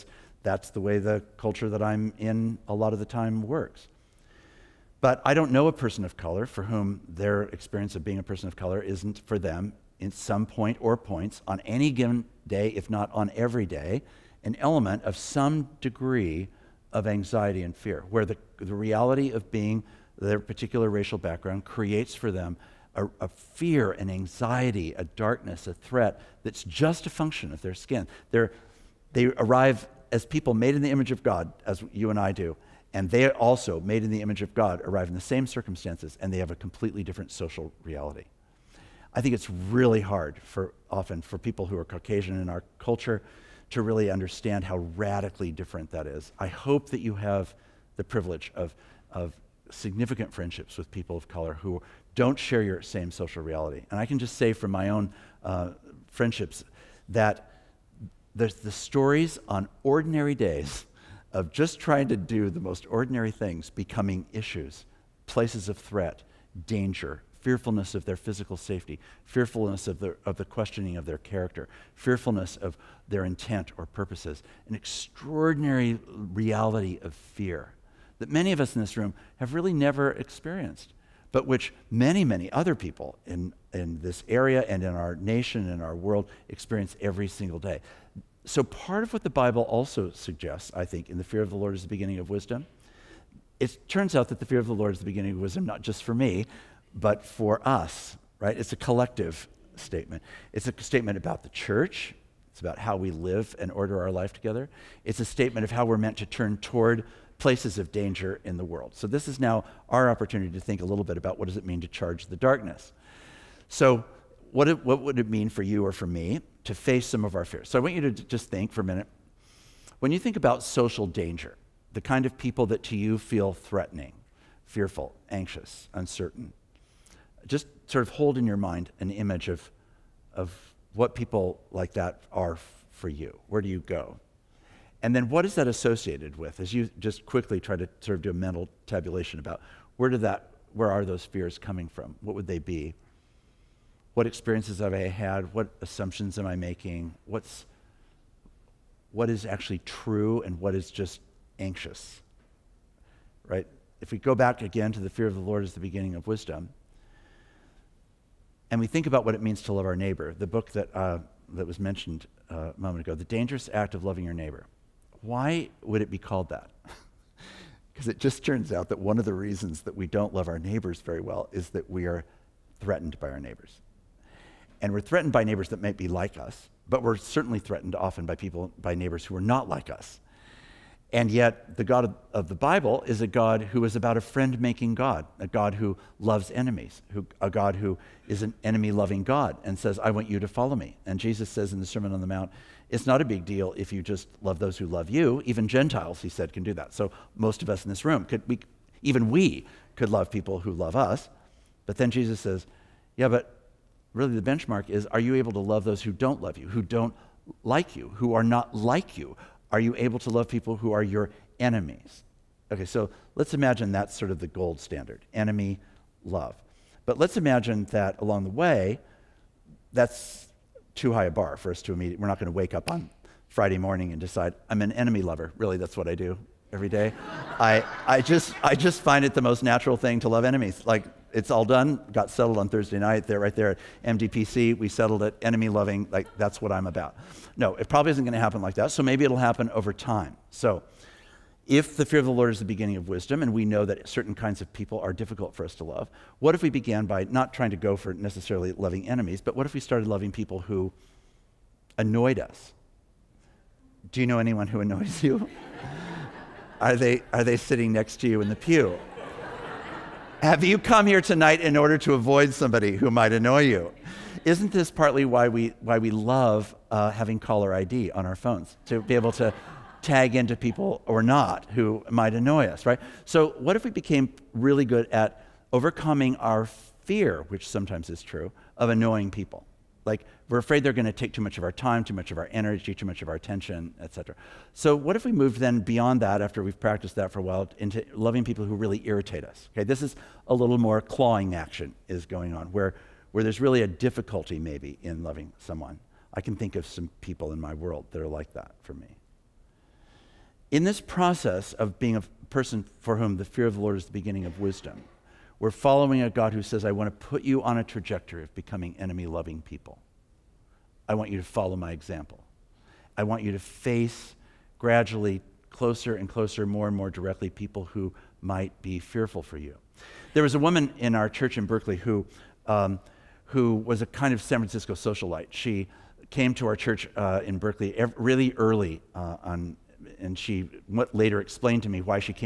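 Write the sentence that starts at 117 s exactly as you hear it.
So I want you to just think for a minute.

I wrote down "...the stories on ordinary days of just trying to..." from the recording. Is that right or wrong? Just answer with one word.
right.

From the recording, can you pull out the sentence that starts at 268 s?
To be able to tag into people or not who might annoy us, right?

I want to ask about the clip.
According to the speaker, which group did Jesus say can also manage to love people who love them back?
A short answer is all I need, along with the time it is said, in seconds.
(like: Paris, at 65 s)
Gentiles, at 195 s.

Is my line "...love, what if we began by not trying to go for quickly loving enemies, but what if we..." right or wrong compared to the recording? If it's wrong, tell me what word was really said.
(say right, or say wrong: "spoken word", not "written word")
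wrong: "necessarily", not "quickly".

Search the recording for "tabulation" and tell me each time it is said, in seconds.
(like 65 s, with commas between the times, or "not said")
138 s.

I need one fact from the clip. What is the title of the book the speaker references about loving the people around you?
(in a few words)
The Dangerous Act of Loving Your Neighbor.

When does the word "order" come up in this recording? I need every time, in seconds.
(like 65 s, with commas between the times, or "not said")
103 s, 261 s.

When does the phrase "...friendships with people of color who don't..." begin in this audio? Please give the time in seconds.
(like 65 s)
50 s.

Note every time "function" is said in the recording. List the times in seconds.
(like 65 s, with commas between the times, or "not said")
27 s.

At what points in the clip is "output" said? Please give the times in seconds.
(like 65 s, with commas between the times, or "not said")
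not said.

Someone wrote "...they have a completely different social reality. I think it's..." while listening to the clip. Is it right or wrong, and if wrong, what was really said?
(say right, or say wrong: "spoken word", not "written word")
right.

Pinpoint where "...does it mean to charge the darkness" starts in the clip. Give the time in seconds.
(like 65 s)
111 s.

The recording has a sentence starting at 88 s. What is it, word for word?
So, part of what the Bible also suggests, I think, in the fear of the Lord is the beginning of wisdom.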